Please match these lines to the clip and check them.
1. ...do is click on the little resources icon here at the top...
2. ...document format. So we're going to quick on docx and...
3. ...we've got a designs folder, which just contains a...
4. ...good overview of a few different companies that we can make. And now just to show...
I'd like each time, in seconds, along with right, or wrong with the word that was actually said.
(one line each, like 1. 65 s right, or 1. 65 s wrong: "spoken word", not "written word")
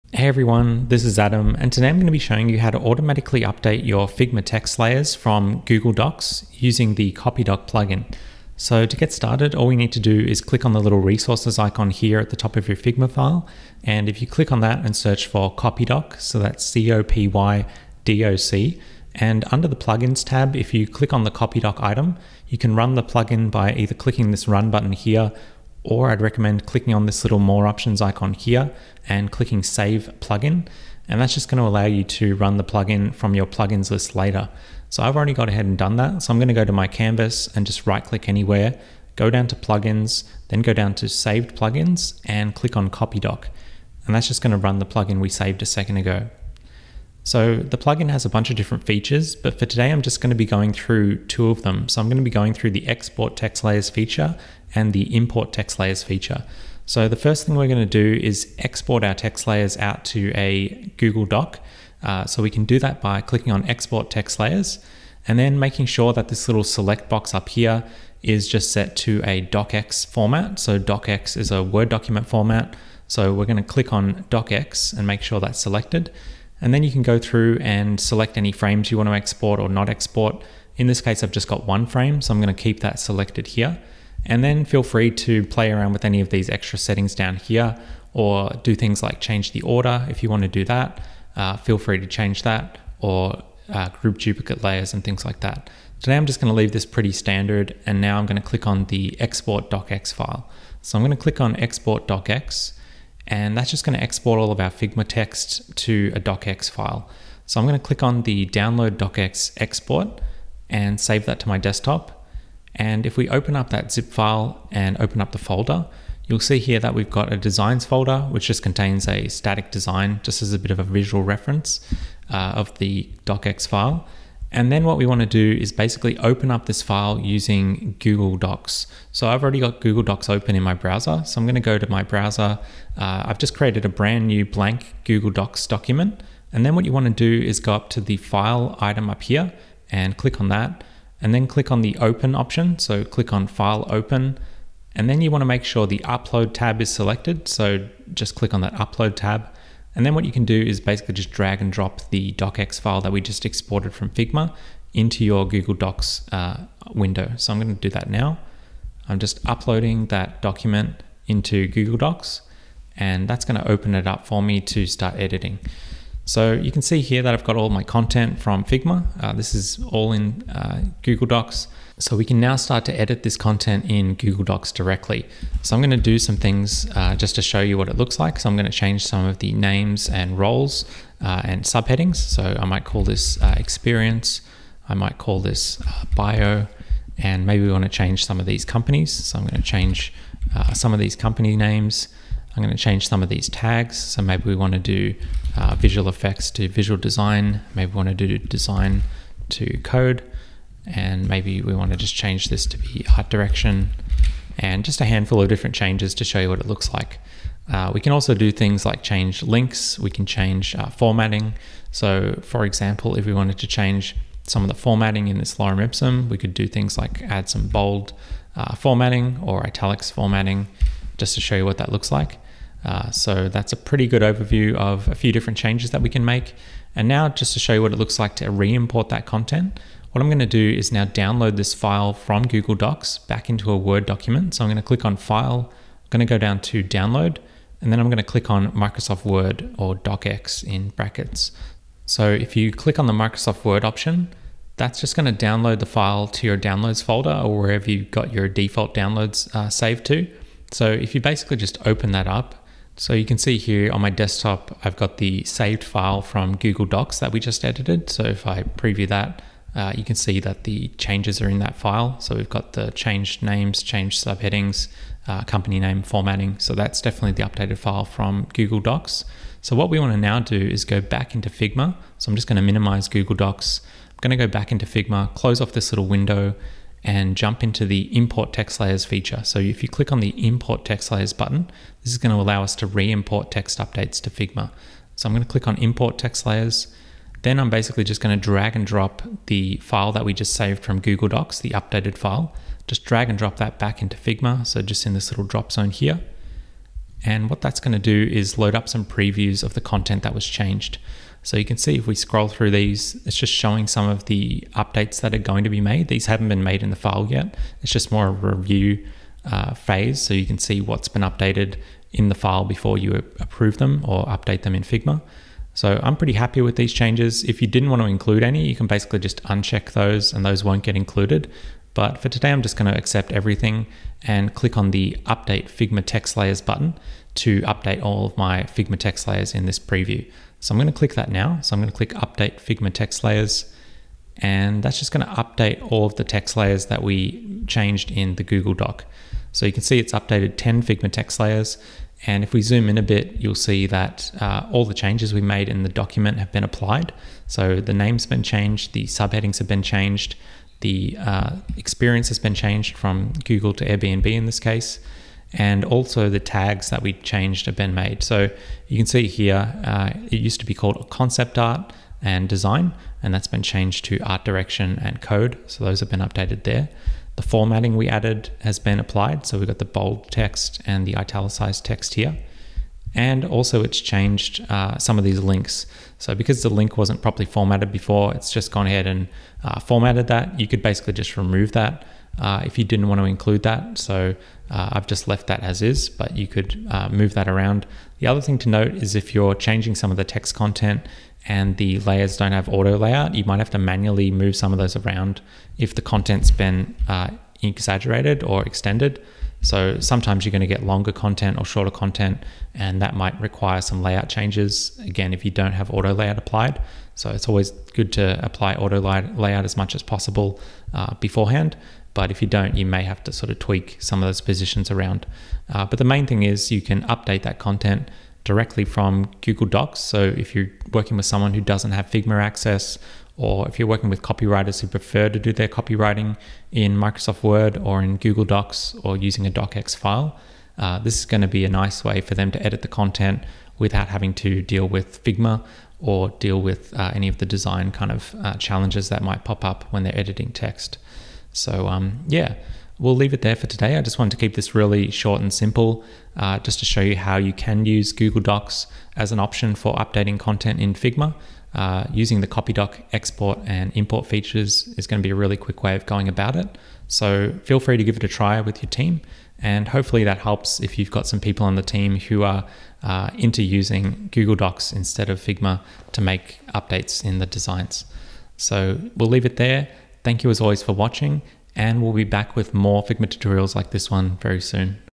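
1. 9 s right
2. 71 s wrong: "click", not "quick"
3. 116 s right
4. 224 s wrong: "changes", not "companies".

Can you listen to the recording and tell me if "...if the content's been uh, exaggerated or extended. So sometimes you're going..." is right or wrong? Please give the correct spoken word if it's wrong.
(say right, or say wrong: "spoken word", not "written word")
right.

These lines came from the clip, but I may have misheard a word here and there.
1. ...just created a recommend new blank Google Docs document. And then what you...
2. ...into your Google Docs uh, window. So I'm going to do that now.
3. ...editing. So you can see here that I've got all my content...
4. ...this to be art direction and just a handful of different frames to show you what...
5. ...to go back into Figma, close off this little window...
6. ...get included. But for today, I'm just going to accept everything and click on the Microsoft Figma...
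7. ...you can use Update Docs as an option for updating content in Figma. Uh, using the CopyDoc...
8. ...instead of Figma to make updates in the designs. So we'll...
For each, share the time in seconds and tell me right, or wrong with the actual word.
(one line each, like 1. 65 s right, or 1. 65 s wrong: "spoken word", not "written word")
1. 133 s wrong: "brand", not "recommend"
2. 154 s right
3. 165 s right
4. 202 s wrong: "changes", not "frames"
5. 274 s right
6. 320 s wrong: "Update", not "Microsoft"
7. 447 s wrong: "Google", not "Update"
8. 464 s right.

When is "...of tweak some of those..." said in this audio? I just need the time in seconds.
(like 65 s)
413 s.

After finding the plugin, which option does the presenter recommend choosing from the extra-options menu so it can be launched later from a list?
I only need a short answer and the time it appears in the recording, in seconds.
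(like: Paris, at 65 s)
Save plugin, at 29 s.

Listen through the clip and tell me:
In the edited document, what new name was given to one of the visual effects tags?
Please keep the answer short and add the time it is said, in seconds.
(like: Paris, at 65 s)
visual design, at 196 s.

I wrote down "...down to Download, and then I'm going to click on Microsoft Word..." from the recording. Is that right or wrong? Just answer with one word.
right.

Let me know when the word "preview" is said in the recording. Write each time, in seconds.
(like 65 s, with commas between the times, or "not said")
258 s, 299 s, 329 s.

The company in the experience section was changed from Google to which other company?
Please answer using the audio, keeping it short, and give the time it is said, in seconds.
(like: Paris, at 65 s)
Airbnb, at 353 s.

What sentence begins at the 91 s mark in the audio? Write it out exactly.
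Uh, feel free to change that or uh, group duplicate layers and things like that.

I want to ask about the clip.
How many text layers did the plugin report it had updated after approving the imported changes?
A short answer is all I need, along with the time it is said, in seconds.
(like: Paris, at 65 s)
10, at 340 s.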